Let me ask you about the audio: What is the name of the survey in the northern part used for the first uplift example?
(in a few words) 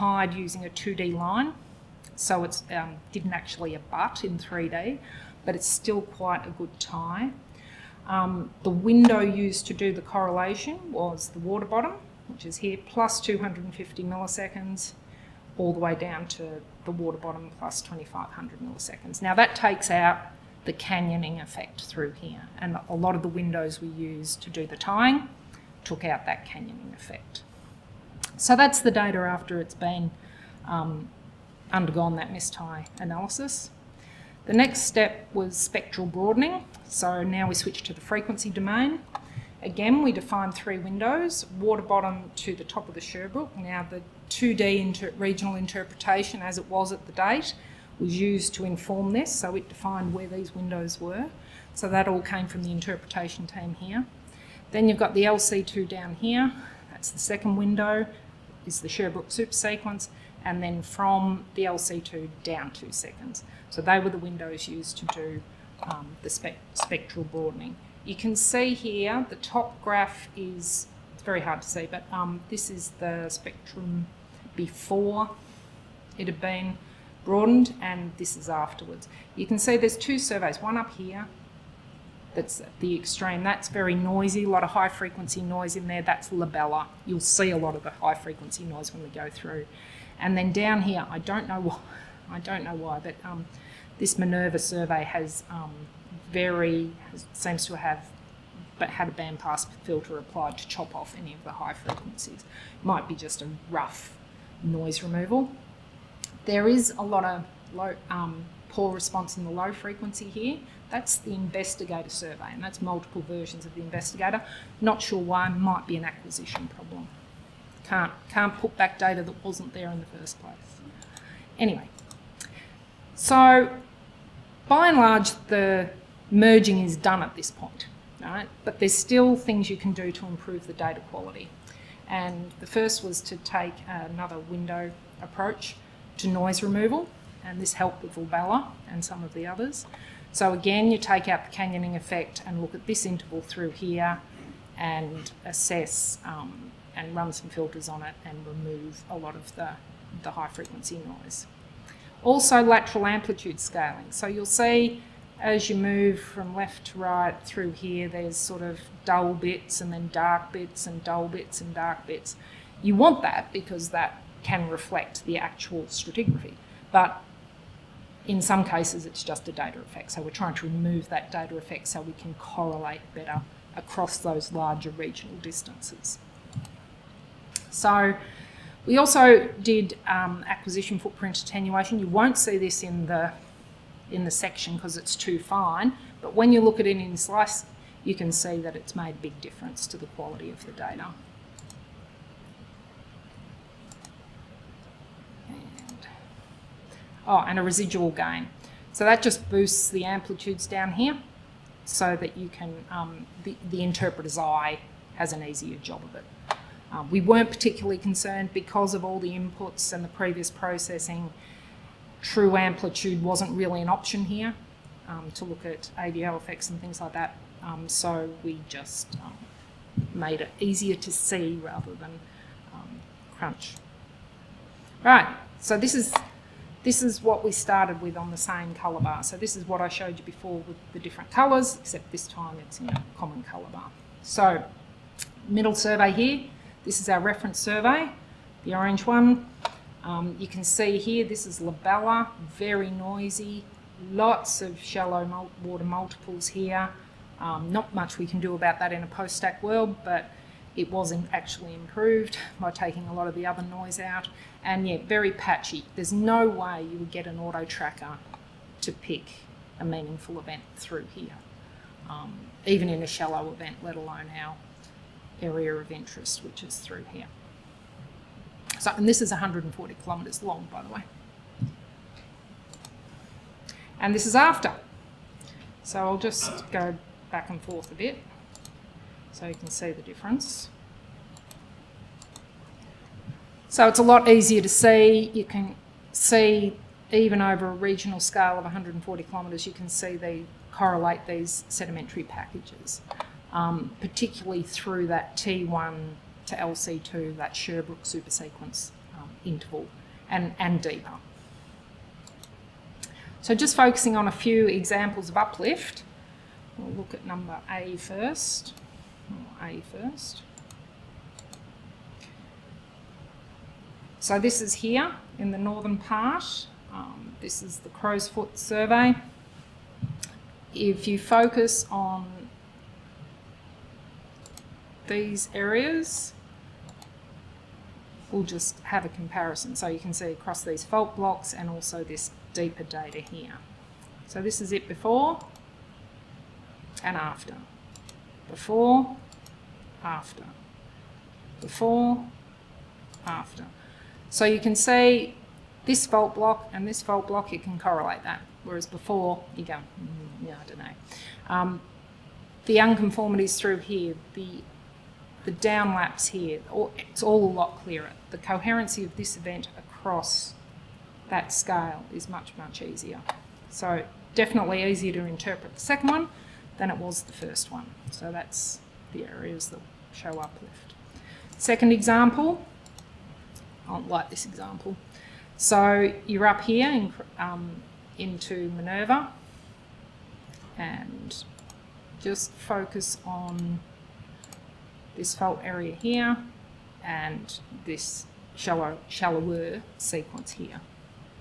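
Crow's Foot.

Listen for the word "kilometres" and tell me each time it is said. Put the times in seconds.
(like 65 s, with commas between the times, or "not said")
270 s, 289 s.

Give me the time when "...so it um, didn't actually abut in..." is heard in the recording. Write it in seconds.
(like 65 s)
2 s.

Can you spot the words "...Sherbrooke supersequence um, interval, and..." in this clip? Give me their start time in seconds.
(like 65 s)
297 s.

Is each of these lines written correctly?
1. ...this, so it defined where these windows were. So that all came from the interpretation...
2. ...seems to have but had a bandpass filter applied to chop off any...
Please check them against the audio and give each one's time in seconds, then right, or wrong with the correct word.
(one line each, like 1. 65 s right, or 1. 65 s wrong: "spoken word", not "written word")
1. 49 s right
2. 97 s right.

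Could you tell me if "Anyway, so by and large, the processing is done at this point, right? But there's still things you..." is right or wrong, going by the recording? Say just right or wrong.
wrong.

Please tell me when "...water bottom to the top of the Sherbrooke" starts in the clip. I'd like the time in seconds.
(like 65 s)
41 s.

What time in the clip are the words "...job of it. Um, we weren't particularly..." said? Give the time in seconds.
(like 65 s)
205 s.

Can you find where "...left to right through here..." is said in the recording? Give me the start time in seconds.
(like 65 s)
156 s.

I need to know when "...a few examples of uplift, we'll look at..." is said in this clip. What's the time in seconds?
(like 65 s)
304 s.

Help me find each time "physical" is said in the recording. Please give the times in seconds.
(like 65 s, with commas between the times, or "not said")
not said.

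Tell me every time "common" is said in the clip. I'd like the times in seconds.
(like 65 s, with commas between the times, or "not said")
233 s.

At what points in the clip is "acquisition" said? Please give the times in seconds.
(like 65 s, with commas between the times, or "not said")
116 s, 180 s.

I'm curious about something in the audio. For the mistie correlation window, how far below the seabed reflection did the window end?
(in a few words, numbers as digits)
2500 milliseconds.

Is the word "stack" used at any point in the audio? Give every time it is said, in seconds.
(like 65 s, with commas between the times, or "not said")
249 s.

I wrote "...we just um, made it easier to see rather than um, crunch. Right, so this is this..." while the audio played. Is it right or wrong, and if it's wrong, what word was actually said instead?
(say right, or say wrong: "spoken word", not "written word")
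right.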